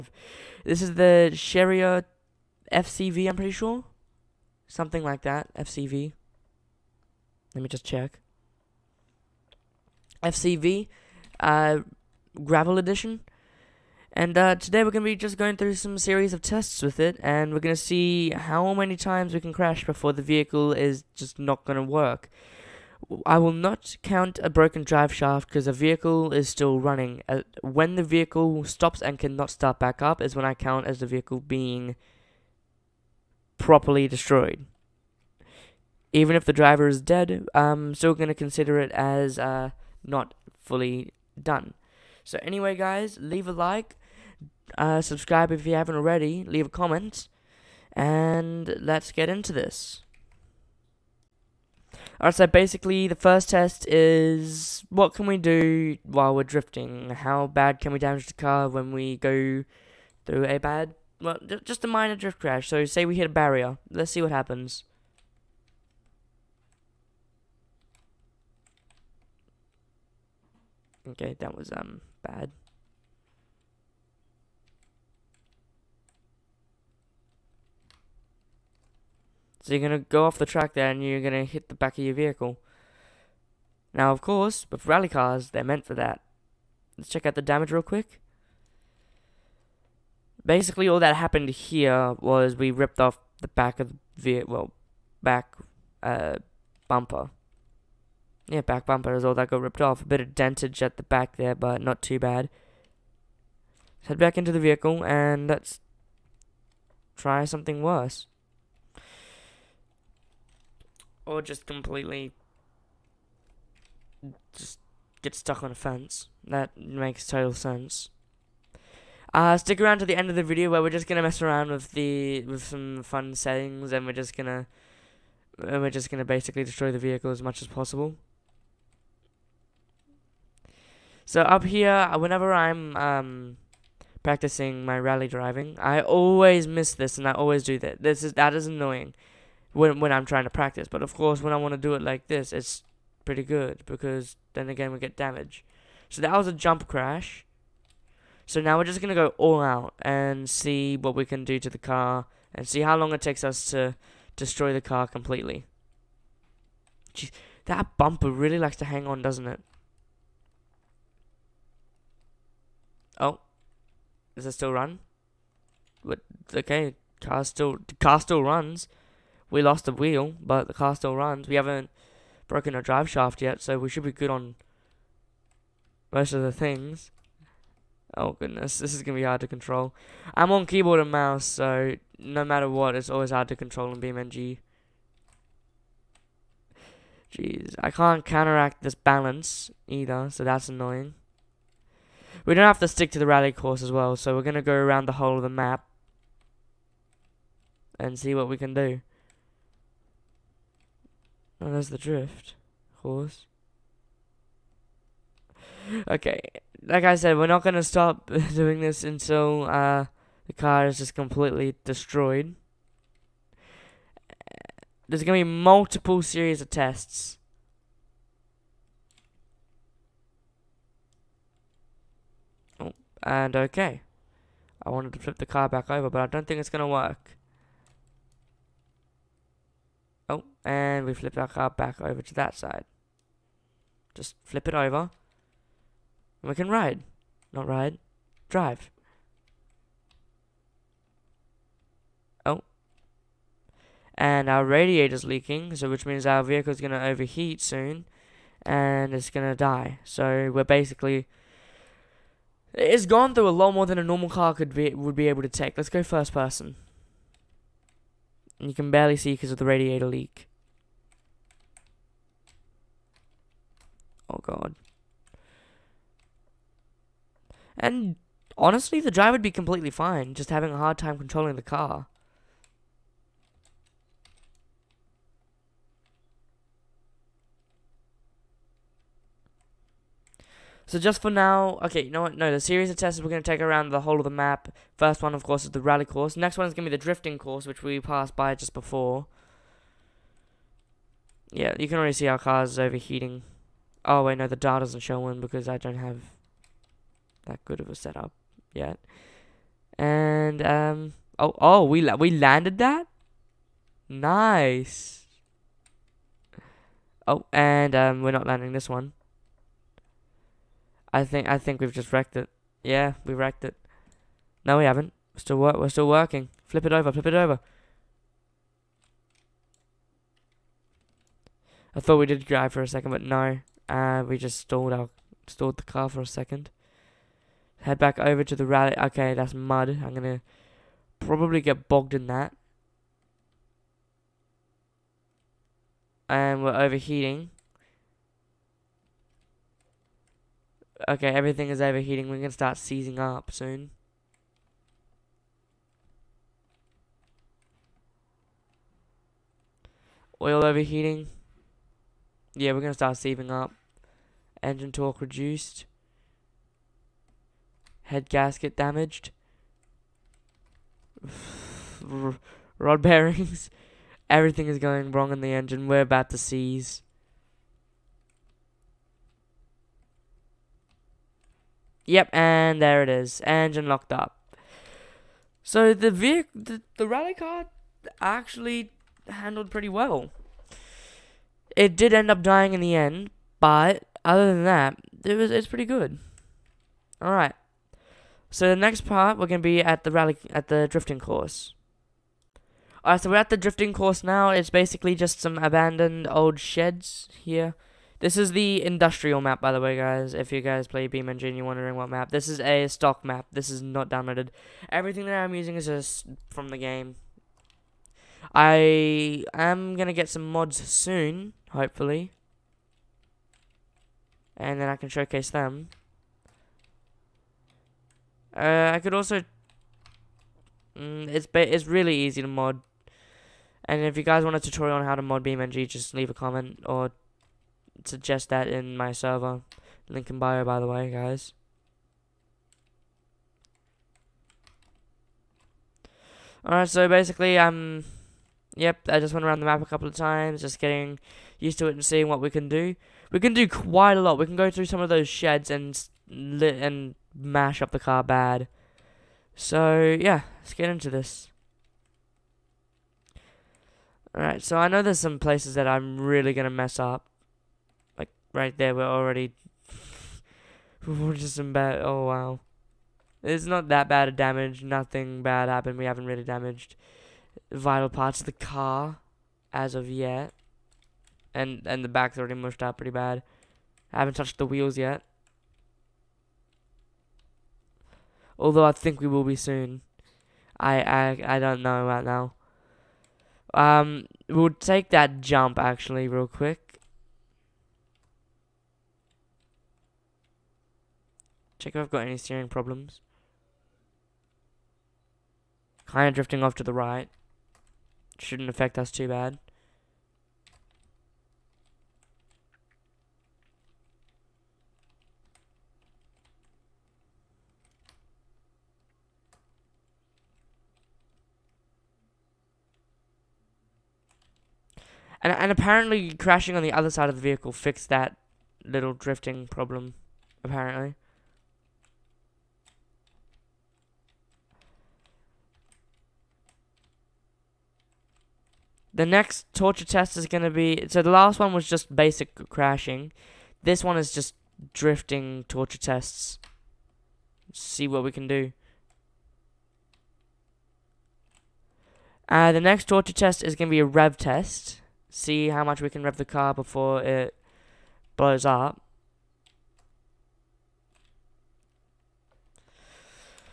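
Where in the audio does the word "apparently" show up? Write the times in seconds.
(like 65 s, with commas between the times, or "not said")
515 s, 520 s.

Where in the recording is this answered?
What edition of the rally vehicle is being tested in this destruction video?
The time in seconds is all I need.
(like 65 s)
12 s.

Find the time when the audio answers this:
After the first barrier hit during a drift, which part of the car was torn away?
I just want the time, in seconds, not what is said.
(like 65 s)
98 s.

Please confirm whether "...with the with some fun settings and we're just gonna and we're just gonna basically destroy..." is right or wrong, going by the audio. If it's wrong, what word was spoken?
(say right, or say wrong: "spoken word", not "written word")
right.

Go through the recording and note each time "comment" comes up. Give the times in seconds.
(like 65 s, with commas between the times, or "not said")
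46 s, 426 s.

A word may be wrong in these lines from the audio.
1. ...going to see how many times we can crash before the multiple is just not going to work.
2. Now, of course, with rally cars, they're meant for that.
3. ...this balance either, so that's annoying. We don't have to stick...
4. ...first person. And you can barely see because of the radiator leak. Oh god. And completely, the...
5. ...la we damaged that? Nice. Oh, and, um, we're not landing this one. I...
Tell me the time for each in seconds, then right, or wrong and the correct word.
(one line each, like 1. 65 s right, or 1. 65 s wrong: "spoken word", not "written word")
1. 17 s wrong: "vehicle", not "multiple"
2. 83 s right
3. 188 s right
4. 256 s wrong: "honestly", not "completely"
5. 302 s wrong: "landed", not "damaged".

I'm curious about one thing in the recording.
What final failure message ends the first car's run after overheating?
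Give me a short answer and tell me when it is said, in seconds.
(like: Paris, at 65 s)
Engine locked up, at 373 s.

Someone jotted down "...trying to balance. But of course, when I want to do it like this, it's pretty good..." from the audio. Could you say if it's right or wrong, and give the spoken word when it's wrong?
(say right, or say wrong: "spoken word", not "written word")
wrong: "practice", not "balance".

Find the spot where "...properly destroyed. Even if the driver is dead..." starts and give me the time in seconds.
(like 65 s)
33 s.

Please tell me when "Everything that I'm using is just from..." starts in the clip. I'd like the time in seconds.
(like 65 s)
404 s.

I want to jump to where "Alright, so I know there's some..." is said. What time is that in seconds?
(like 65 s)
454 s.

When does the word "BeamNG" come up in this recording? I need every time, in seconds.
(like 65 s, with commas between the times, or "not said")
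184 s, 401 s, 425 s.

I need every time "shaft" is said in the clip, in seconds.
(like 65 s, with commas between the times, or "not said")
25 s, 173 s.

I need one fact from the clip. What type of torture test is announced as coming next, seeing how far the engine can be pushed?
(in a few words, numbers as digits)
rev test.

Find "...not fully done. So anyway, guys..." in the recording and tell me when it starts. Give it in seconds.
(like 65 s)
40 s.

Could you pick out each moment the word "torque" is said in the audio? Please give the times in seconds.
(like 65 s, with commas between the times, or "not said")
354 s.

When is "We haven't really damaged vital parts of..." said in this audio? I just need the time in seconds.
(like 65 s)
465 s.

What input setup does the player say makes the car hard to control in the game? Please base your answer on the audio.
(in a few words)
keyboard and mouse.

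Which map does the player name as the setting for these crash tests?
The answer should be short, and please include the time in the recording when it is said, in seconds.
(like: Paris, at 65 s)
industrial map, at 398 s.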